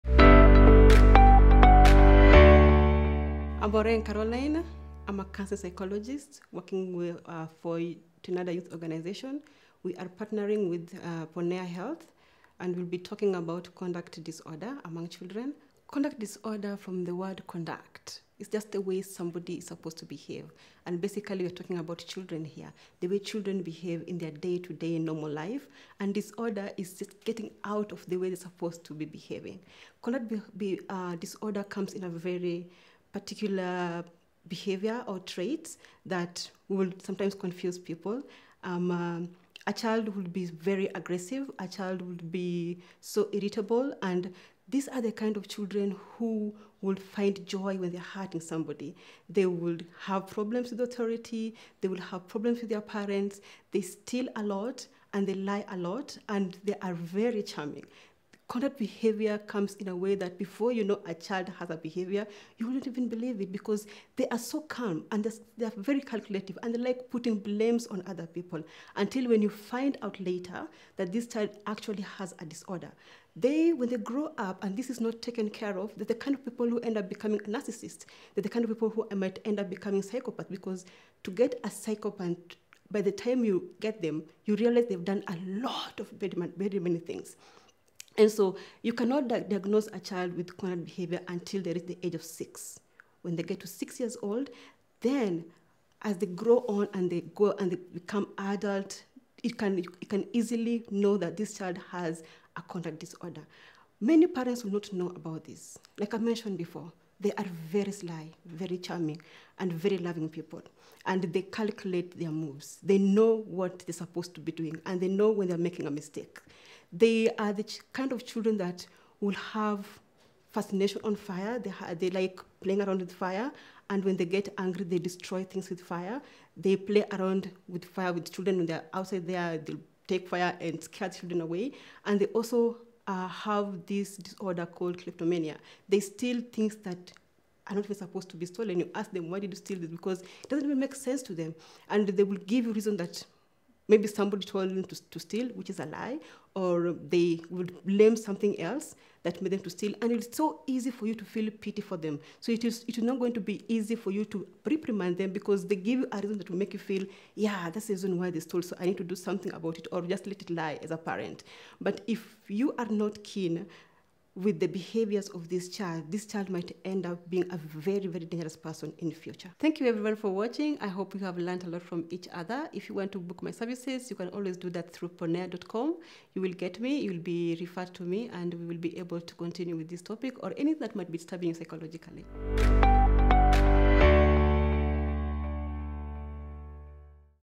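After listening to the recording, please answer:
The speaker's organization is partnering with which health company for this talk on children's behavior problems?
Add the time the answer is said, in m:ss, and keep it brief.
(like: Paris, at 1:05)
Ponea Health, at 0:11.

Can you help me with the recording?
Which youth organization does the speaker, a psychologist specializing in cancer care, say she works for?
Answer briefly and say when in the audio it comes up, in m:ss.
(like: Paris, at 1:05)
TINADA Youth Organization, at 0:08.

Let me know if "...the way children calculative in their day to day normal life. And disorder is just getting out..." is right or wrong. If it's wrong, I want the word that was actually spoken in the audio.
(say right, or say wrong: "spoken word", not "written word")
wrong: "behave", not "calculative".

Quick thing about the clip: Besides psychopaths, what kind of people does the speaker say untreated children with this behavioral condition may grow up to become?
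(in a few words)
narcissists.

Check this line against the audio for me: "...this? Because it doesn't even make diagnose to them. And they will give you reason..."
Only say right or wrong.
wrong.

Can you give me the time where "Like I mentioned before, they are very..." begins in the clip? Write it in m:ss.
1:45.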